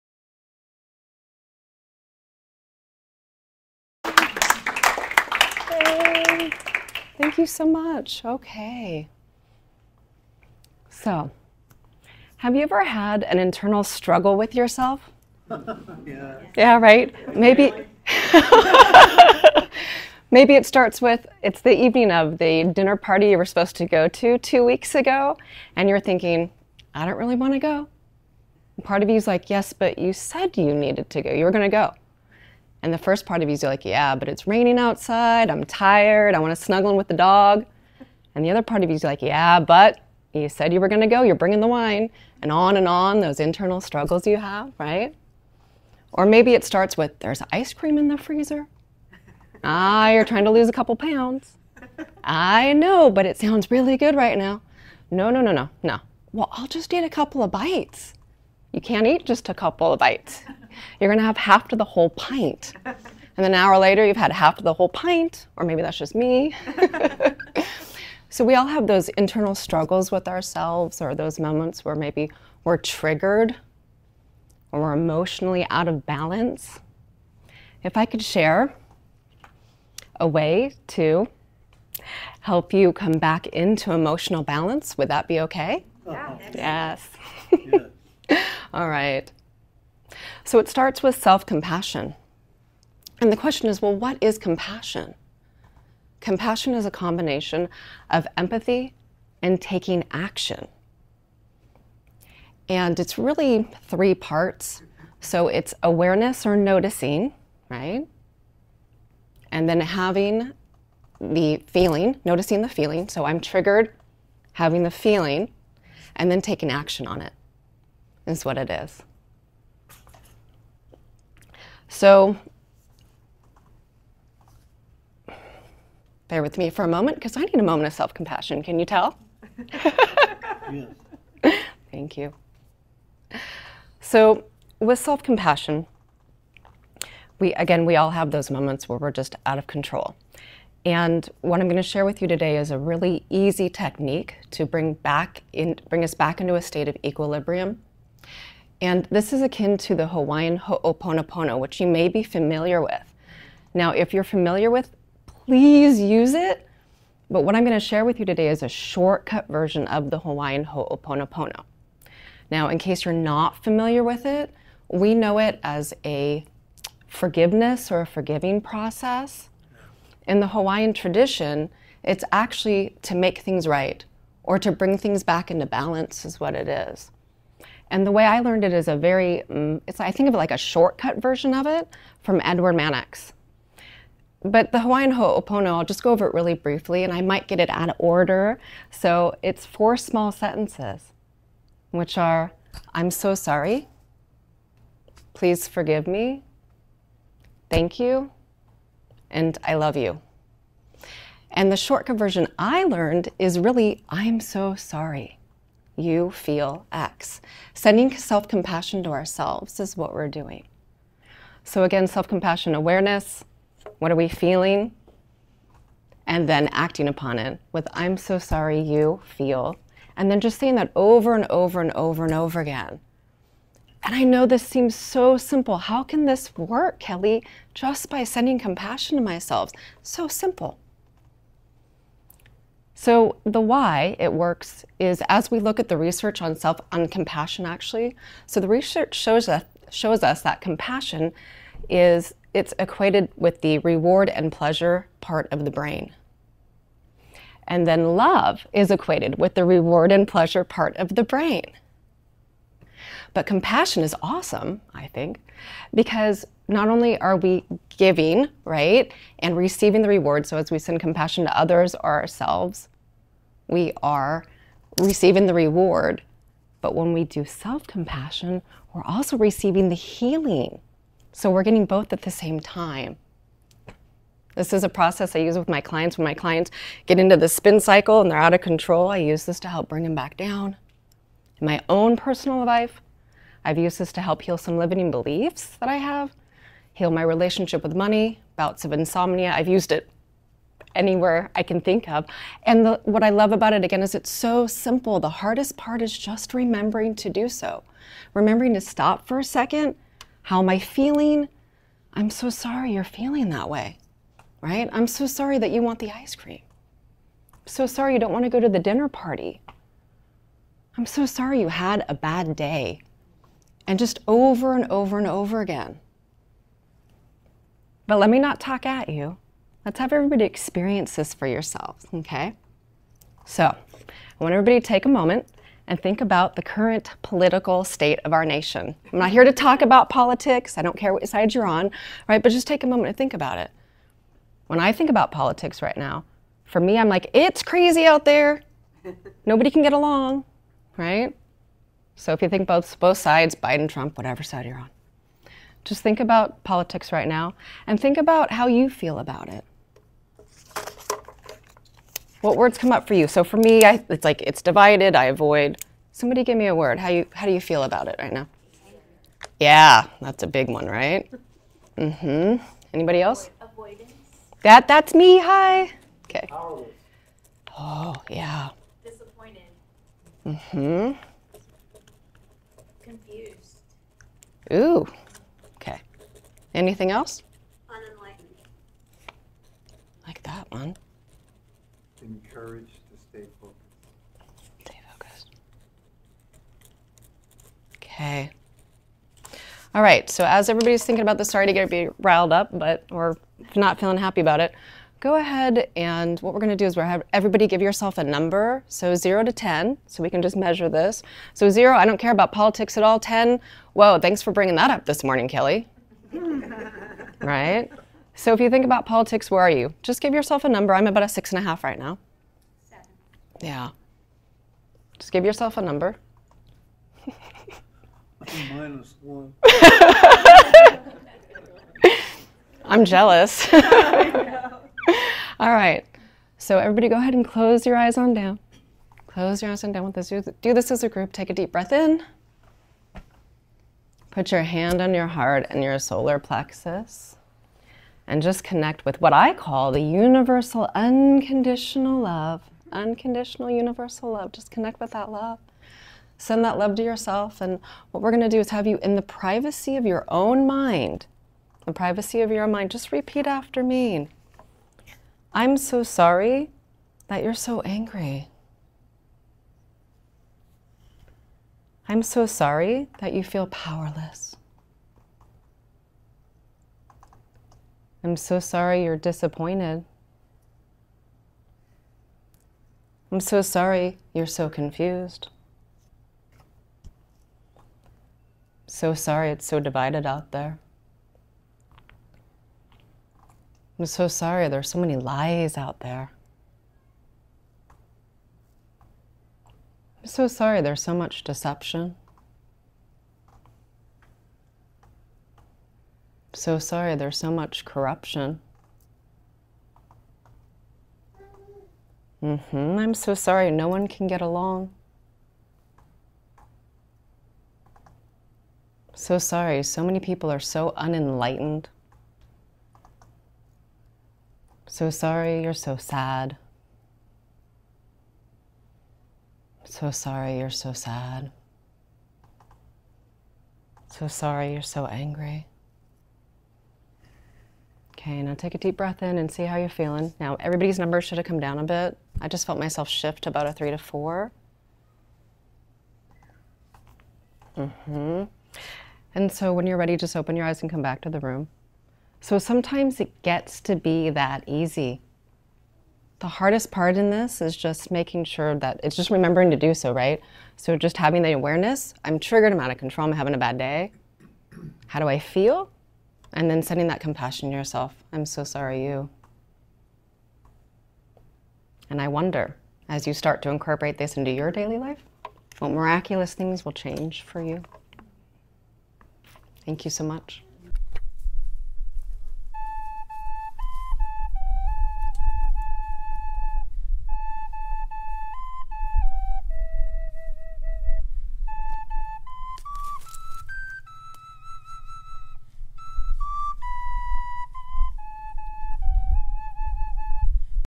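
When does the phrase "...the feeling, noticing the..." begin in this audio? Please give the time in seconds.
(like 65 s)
111 s.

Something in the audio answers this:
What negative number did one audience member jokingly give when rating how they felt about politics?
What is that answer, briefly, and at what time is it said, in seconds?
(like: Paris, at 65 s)
-1, at 418 s.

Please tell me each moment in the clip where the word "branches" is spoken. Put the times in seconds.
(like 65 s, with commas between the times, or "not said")
not said.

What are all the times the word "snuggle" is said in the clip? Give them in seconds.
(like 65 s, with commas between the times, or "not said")
36 s.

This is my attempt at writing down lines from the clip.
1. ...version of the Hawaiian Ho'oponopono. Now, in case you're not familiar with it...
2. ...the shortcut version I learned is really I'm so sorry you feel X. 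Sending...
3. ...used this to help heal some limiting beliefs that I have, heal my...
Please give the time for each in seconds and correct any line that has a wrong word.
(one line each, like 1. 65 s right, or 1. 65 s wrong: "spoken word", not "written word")
1. 159 s right
2. 201 s right
3. 283 s right.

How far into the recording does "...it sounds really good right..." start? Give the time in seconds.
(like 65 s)
53 s.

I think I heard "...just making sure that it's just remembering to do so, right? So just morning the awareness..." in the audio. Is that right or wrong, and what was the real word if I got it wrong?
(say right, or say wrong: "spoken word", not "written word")
wrong: "having", not "morning".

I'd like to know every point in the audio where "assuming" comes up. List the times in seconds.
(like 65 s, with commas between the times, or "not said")
not said.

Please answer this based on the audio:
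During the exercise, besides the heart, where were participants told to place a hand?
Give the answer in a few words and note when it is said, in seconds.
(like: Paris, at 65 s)
Solar plexus, at 435 s.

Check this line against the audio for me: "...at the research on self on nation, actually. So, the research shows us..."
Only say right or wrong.
wrong.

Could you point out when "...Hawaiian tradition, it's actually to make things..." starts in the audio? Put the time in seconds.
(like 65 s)
170 s.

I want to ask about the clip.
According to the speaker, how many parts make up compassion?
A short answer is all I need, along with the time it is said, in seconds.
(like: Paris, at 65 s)
3, at 103 s.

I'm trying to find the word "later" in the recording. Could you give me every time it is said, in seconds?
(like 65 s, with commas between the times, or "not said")
63 s.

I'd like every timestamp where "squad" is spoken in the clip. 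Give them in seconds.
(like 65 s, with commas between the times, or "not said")
not said.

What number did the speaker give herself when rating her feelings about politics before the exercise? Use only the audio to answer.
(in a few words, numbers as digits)
6.5.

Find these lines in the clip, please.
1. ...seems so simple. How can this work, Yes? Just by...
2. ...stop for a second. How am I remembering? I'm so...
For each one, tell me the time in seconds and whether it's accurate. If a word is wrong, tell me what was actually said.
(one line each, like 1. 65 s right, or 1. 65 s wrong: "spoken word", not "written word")
1. 224 s wrong: "Kelly", not "Yes"
2. 298 s wrong: "feeling", not "remembering".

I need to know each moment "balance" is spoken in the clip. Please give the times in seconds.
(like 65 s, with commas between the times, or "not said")
76 s, 84 s, 175 s.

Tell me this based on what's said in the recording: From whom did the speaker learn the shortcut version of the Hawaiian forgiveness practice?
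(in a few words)
Edward Mannix.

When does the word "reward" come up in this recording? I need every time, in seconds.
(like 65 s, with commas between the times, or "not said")
243 s, 249 s, 260 s, 265 s.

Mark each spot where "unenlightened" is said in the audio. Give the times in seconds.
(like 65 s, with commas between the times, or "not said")
377 s, 510 s.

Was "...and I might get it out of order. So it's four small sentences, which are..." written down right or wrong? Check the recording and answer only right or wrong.
right.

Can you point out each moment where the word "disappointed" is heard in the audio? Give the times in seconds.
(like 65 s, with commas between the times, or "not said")
369 s, 469 s.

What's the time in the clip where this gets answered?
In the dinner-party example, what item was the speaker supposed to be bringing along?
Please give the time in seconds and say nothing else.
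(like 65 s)
41 s.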